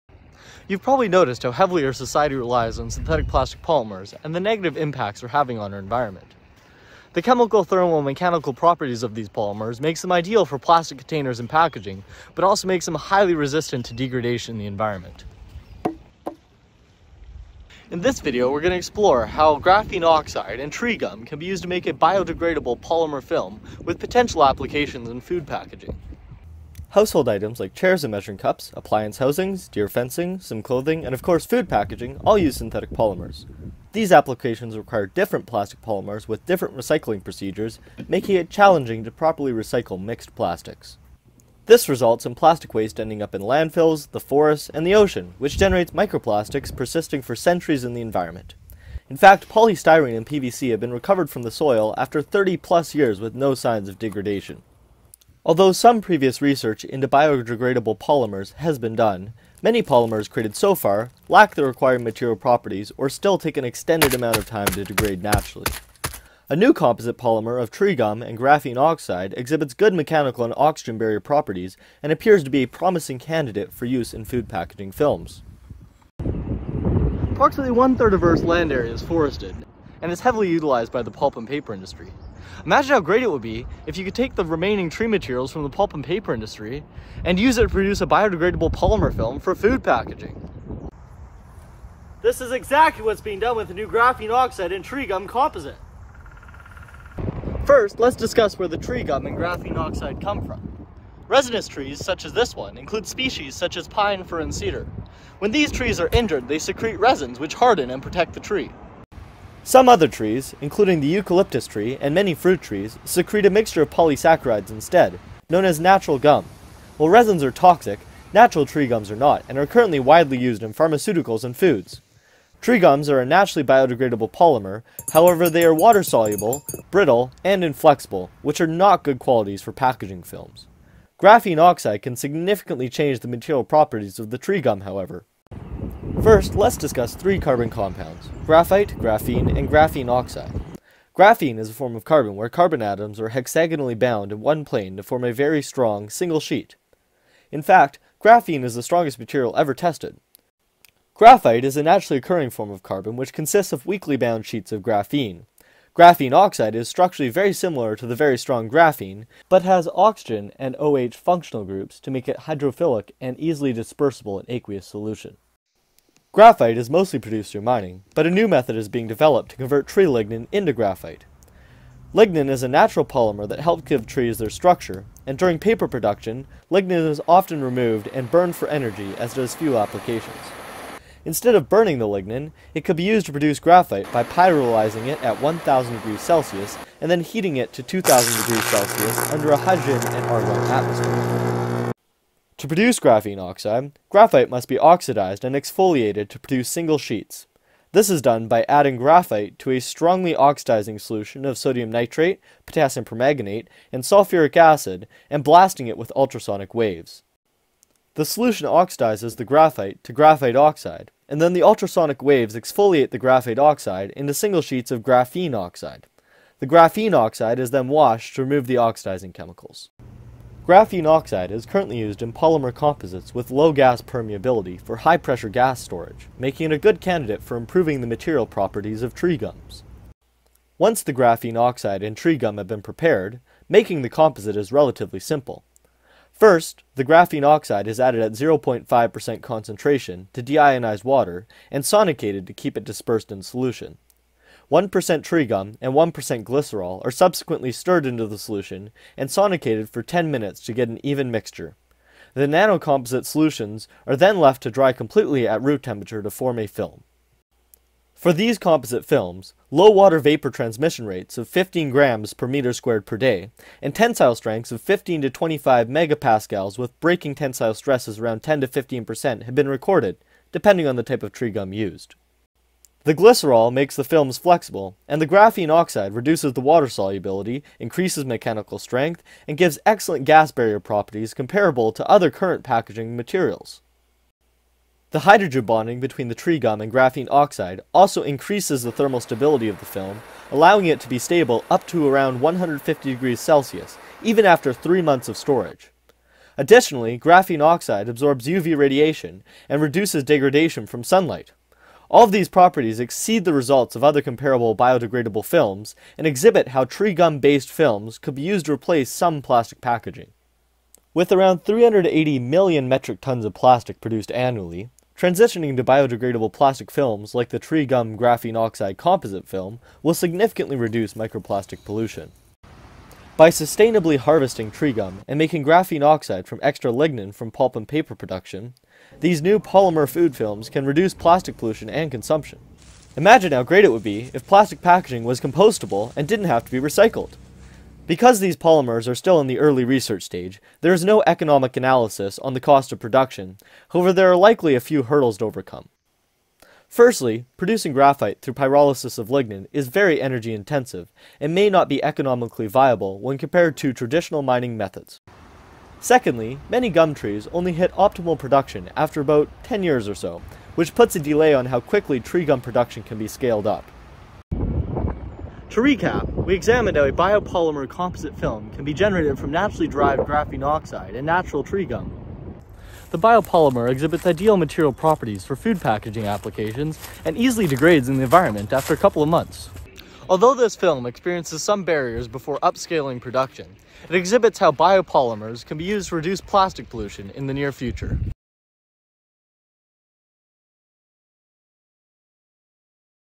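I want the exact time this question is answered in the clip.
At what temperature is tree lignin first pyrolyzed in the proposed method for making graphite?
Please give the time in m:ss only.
3:05.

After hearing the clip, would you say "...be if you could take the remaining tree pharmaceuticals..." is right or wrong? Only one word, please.
wrong.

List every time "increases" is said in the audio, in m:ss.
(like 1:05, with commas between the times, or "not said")
4:37, 4:48.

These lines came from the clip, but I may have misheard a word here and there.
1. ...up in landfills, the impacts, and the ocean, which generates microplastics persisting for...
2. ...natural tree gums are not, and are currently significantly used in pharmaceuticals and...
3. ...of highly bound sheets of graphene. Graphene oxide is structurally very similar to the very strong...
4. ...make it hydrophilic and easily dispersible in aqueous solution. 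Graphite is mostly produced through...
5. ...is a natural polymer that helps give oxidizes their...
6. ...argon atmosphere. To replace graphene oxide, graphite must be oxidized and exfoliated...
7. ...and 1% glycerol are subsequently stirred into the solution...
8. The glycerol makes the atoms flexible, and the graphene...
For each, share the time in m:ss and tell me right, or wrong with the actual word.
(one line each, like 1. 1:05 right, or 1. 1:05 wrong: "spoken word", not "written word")
1. 0:43 wrong: "forests", not "impacts"
2. 1:58 wrong: "widely", not "significantly"
3. 2:33 wrong: "weakly", not "highly"
4. 2:42 right
5. 2:52 wrong: "trees", not "oxidizes"
6. 3:10 wrong: "produce", not "replace"
7. 4:05 right
8. 4:33 wrong: "films", not "atoms".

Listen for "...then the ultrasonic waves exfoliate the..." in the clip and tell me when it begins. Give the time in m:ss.
3:31.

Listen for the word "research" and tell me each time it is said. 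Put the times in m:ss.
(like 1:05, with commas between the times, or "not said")
0:56, 5:39.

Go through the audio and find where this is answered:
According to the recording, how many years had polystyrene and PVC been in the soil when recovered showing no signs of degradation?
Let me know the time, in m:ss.
0:52.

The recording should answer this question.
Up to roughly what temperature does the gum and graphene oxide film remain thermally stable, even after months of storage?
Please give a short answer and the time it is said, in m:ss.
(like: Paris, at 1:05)
150 degrees Celsius, at 4:52.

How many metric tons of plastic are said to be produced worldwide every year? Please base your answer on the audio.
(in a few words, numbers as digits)
380 million.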